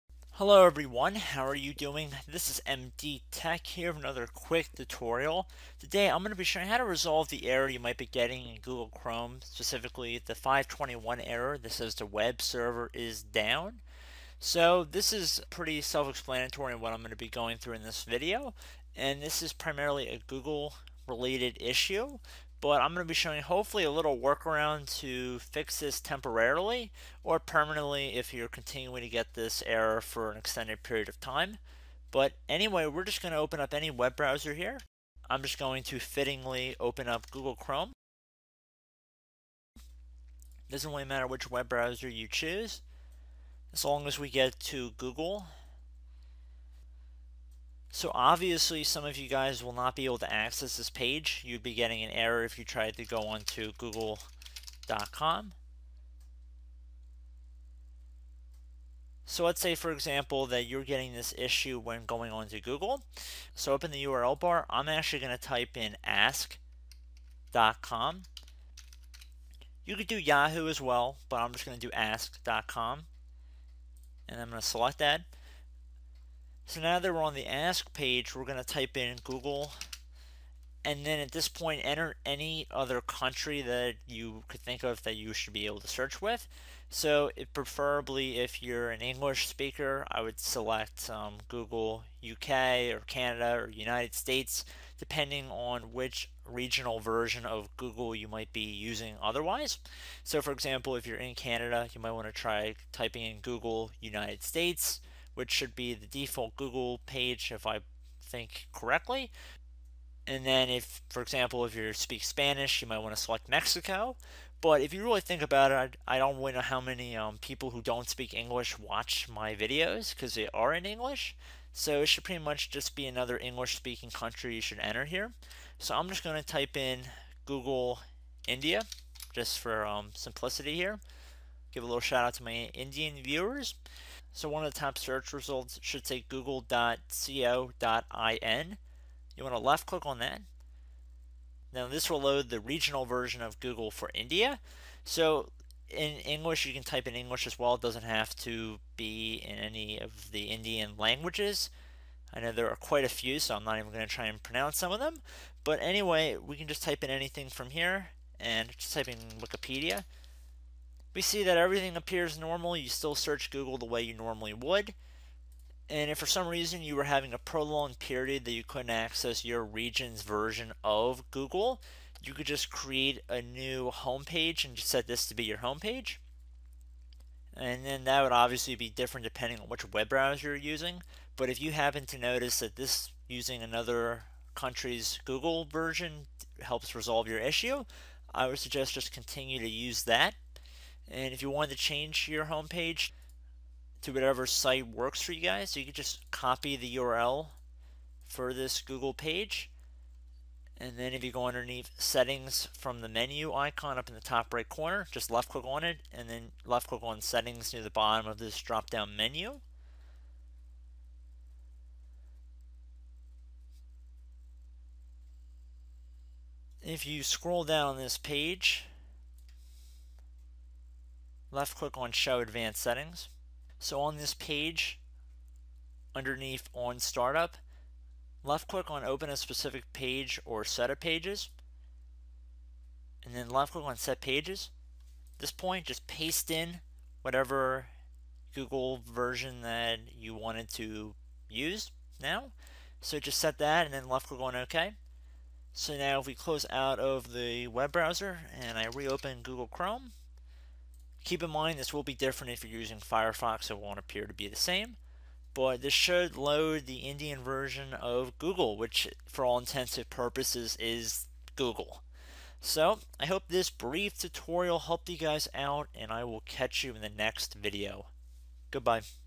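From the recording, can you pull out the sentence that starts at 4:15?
But this should load the Indian version of Google, which for all intents and purposes is Google.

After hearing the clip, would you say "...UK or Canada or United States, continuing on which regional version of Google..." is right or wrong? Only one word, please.
wrong.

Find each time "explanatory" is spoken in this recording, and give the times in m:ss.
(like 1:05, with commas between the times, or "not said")
0:15.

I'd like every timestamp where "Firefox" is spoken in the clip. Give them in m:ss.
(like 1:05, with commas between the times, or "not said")
4:12.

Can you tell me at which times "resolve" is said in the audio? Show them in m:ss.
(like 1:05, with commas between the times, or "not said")
0:06, 3:06.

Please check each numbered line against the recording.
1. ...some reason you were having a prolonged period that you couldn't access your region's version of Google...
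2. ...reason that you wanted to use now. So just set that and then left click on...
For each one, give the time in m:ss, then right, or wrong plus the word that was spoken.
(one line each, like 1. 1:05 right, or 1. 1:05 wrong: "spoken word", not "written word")
1. 2:46 right
2. 3:59 wrong: "version", not "reason".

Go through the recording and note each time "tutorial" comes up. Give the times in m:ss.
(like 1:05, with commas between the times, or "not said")
0:04, 4:24.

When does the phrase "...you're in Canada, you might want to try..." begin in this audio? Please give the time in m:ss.
1:41.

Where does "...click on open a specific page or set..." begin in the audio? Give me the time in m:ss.
3:48.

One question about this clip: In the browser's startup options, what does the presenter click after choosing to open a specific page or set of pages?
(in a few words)
set pages.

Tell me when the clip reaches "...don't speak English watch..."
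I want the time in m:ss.
1:57.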